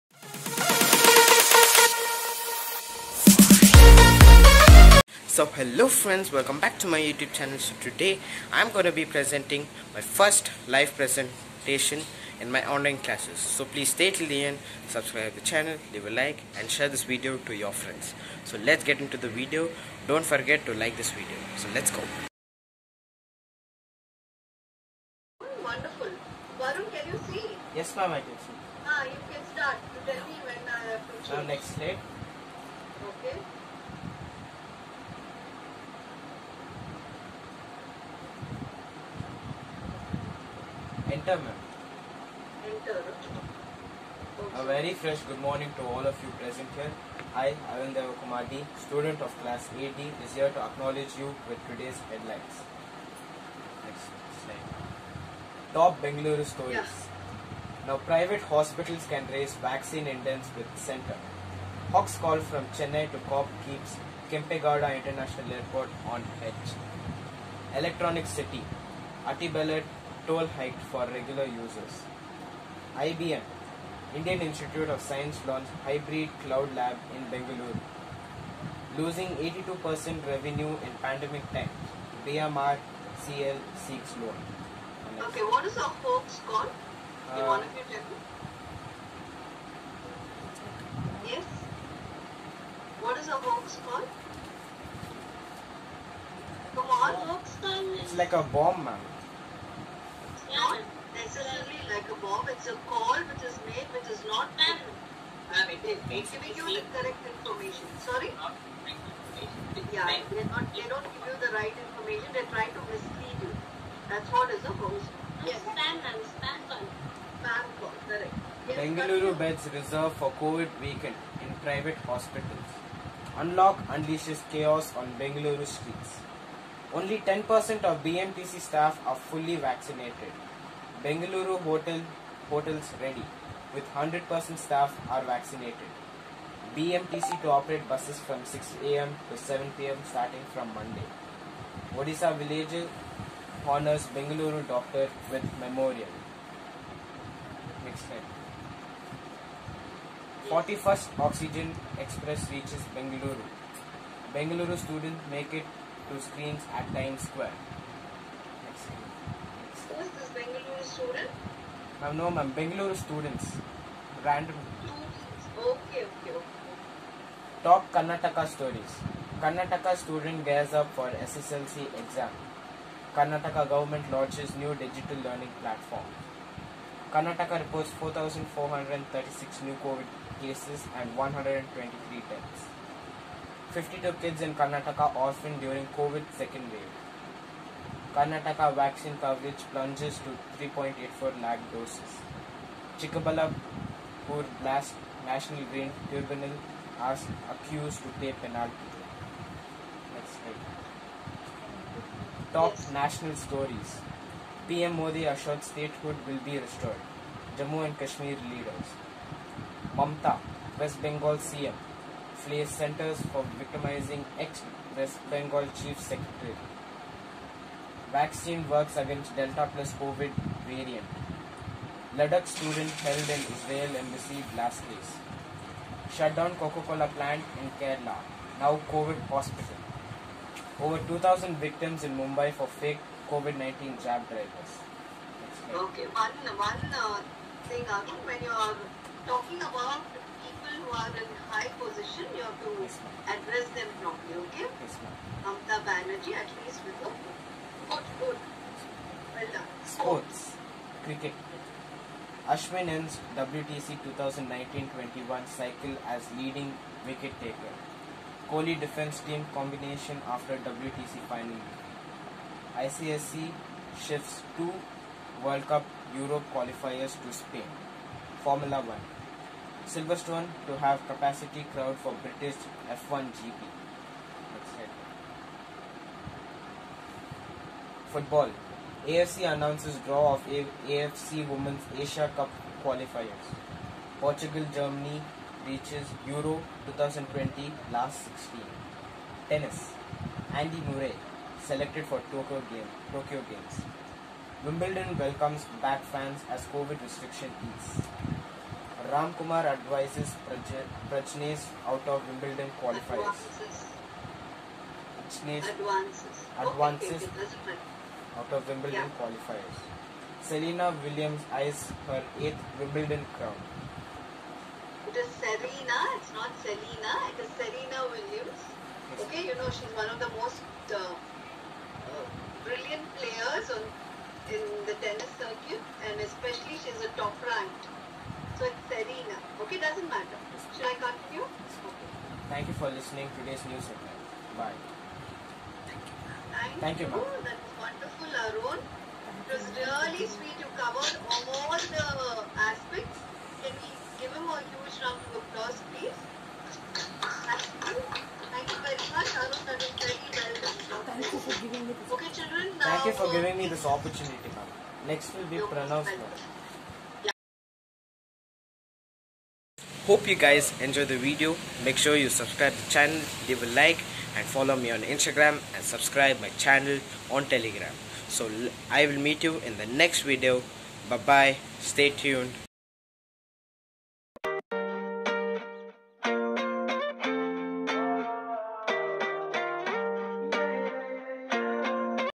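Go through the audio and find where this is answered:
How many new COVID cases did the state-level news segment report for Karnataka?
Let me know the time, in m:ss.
2:57.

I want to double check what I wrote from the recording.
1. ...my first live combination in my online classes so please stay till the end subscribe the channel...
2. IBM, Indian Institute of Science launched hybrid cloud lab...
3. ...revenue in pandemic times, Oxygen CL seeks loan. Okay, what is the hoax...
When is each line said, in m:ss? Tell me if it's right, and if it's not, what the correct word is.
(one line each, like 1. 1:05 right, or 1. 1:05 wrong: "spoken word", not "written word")
1. 0:09 wrong: "presentation", not "combination"
2. 1:12 right
3. 1:20 wrong: "BMR", not "Oxygen".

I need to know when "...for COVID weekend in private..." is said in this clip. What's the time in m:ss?
2:00.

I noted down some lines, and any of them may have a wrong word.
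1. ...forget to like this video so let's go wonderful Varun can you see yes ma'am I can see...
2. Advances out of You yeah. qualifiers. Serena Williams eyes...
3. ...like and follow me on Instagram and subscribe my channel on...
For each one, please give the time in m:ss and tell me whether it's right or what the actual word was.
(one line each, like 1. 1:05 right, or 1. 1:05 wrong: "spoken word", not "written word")
1. 0:20 right
2. 5:07 wrong: "Wimbledon", not "You"
3. 6:03 right.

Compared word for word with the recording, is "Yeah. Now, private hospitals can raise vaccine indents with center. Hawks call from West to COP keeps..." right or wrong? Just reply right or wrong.
wrong.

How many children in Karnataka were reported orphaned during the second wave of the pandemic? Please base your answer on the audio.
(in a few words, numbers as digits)
52.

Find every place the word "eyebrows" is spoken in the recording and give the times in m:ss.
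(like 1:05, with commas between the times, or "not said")
not said.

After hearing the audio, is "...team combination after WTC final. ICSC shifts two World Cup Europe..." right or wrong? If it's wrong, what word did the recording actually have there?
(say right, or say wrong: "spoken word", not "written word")
right.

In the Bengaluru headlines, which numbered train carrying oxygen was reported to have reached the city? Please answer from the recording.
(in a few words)
41st Oxygen Express.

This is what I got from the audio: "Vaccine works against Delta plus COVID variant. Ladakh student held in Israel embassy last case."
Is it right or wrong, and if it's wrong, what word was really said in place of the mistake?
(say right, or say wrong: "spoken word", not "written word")
right.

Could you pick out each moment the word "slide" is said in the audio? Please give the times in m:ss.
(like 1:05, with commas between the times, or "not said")
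0:31, 0:54, 2:28, 3:20.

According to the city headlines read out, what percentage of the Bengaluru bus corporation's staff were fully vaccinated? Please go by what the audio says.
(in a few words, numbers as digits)
10%.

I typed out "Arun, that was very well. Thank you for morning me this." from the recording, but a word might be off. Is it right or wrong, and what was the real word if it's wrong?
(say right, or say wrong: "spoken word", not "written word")
wrong: "giving", not "morning".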